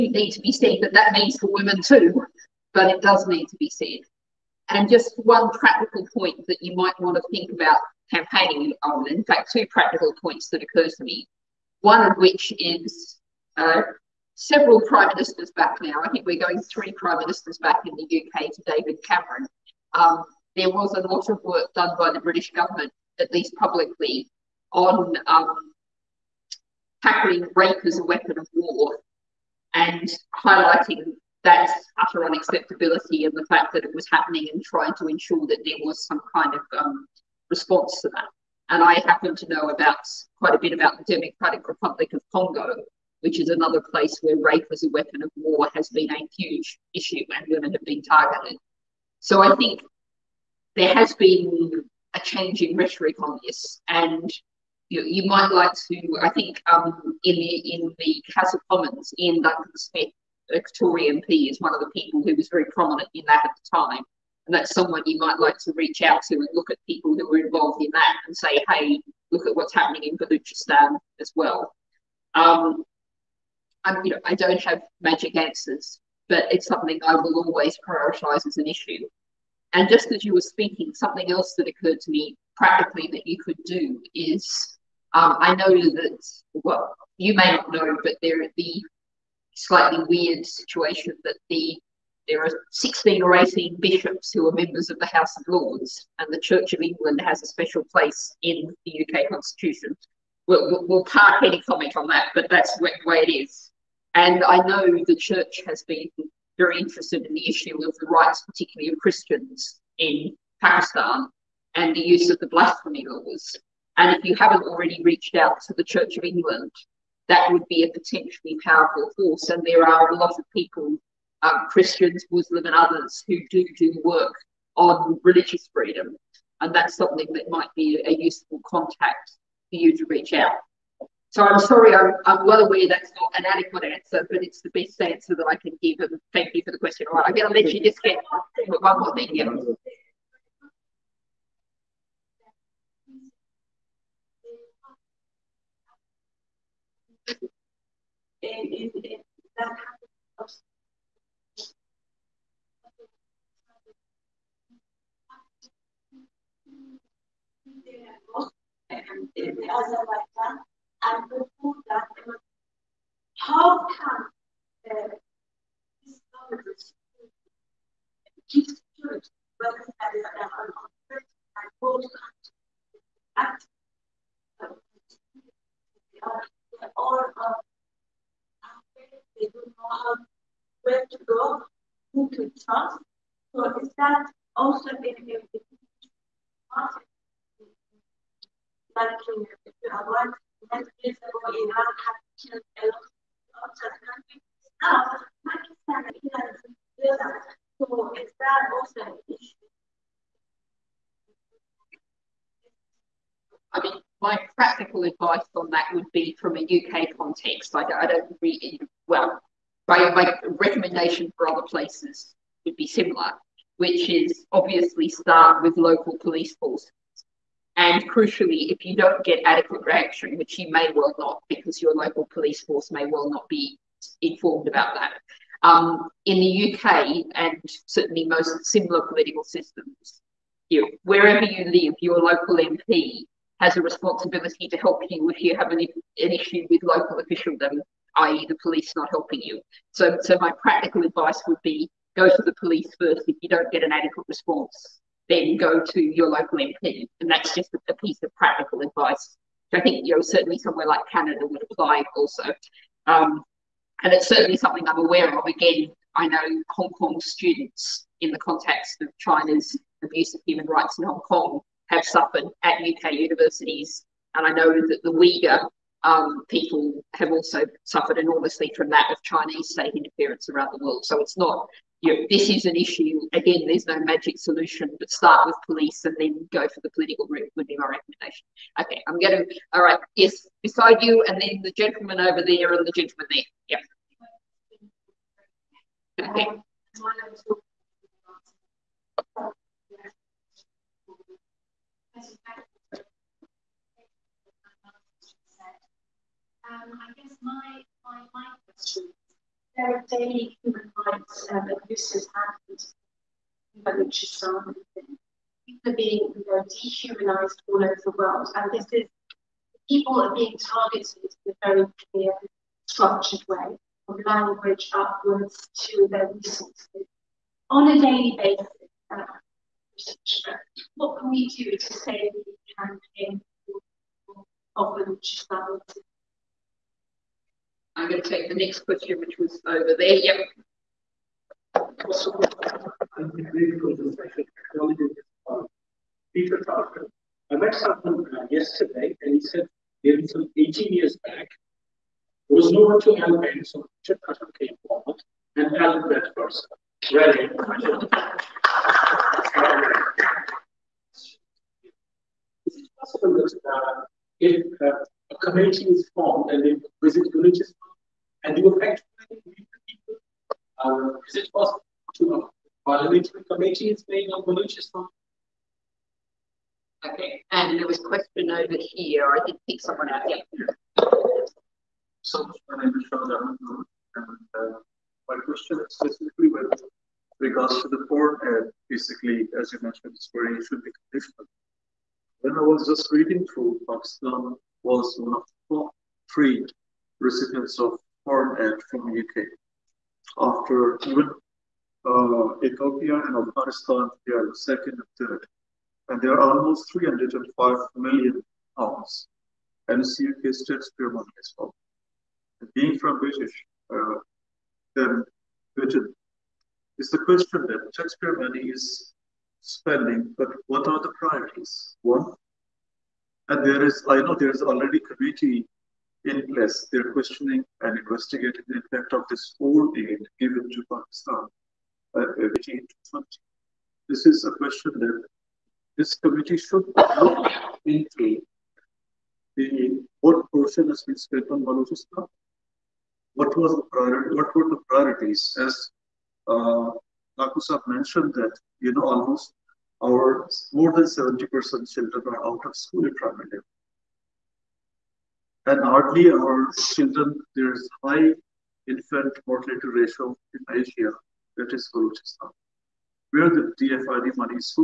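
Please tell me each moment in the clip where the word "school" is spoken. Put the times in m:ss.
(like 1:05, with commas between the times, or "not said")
7:22.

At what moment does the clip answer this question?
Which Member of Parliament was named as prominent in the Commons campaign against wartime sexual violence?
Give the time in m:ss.
0:59.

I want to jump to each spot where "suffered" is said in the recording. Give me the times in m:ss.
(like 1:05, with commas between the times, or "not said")
4:22, 4:27.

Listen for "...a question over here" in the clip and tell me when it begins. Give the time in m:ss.
6:07.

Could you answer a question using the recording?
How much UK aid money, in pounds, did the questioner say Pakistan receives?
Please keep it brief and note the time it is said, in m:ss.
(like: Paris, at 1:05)
305 million pounds, at 6:36.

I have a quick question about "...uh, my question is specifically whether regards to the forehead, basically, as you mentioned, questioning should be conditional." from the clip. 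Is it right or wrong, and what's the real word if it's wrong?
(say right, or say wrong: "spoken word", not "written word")
wrong: "swearing", not "questioning".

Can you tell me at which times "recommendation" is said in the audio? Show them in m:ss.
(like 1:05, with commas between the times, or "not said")
3:30, 4:37.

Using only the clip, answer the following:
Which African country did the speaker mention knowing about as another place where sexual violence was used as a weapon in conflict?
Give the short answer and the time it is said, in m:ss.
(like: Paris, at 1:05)
Democratic Republic of Congo, at 0:41.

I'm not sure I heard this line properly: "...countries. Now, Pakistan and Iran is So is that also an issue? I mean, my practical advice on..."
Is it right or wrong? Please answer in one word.
right.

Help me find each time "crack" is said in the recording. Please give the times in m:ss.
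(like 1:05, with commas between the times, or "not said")
not said.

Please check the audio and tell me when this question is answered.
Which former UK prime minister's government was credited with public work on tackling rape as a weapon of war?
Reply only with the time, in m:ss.
0:18.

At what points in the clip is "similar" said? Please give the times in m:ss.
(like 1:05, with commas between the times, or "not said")
3:32, 3:48.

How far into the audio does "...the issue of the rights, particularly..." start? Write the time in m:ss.
1:47.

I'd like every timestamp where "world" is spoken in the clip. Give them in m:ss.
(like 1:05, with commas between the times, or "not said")
4:30, 5:08.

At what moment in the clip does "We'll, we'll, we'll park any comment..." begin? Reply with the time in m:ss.
1:40.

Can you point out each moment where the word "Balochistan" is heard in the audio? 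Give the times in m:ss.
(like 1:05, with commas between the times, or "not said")
1:10, 7:11, 7:31.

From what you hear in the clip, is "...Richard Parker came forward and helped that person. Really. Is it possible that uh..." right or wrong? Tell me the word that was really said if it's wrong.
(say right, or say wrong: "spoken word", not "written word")
right.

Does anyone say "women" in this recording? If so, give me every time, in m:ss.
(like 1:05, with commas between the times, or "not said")
0:01, 0:47.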